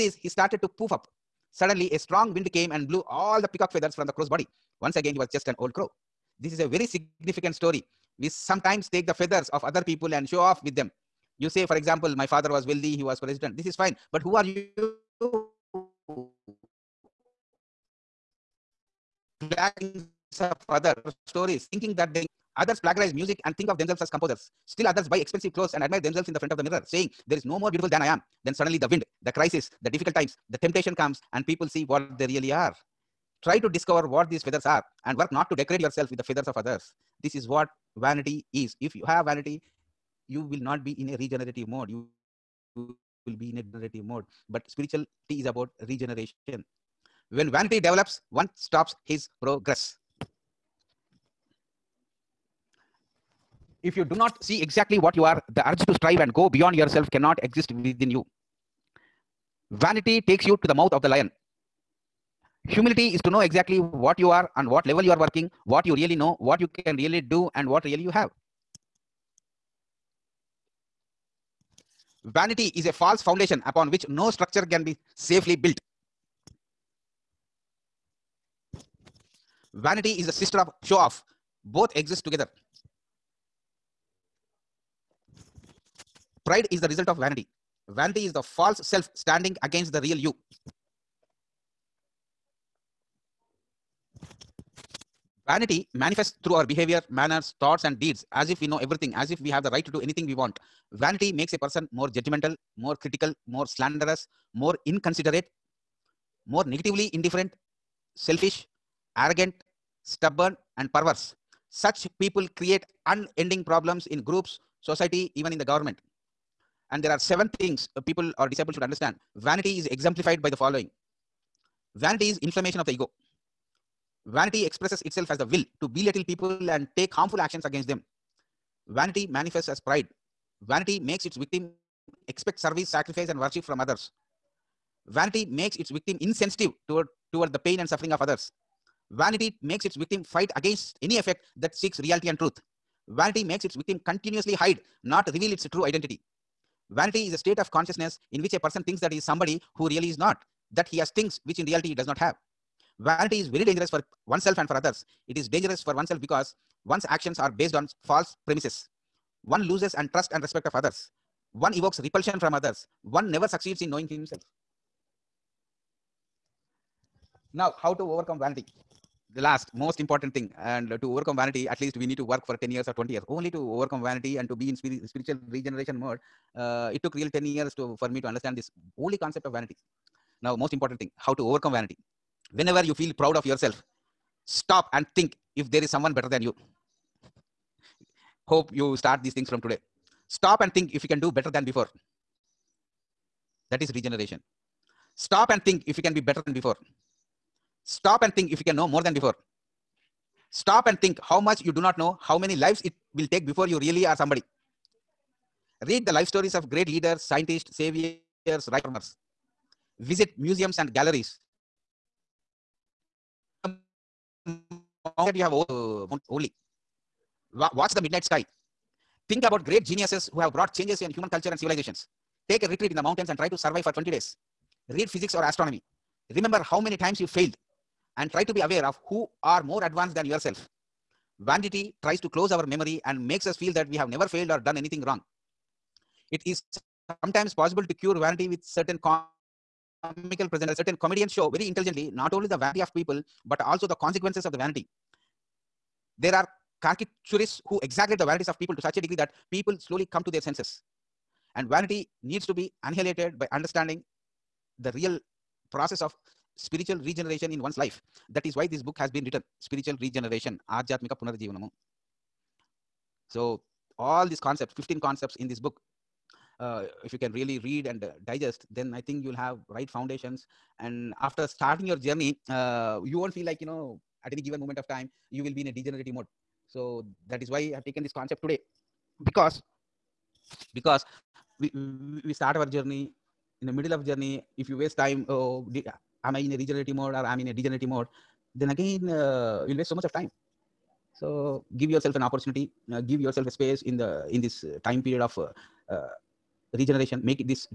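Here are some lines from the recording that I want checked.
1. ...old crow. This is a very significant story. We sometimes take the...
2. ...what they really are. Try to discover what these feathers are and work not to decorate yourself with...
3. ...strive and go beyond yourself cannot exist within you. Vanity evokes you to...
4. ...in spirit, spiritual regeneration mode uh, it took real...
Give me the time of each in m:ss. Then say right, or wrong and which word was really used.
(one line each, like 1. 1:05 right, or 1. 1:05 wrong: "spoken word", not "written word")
1. 0:05 right
2. 0:31 right
3. 0:55 wrong: "takes", not "evokes"
4. 2:54 right.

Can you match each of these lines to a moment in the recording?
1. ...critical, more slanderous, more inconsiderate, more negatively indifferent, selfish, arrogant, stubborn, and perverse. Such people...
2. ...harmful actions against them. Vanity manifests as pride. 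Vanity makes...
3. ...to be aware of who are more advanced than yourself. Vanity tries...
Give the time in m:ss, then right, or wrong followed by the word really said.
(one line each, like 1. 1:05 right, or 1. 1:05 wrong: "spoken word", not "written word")
1. 1:42 right
2. 2:07 right
3. 3:48 right.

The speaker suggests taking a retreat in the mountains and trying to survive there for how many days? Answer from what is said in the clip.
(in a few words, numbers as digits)
20.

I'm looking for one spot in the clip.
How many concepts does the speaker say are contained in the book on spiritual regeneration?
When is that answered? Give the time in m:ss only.
4:24.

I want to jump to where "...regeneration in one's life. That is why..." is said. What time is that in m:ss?
4:16.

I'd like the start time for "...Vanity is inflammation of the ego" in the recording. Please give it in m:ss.
2:01.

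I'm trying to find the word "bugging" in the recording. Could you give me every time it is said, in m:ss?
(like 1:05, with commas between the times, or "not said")
not said.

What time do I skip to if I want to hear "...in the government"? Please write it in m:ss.
1:55.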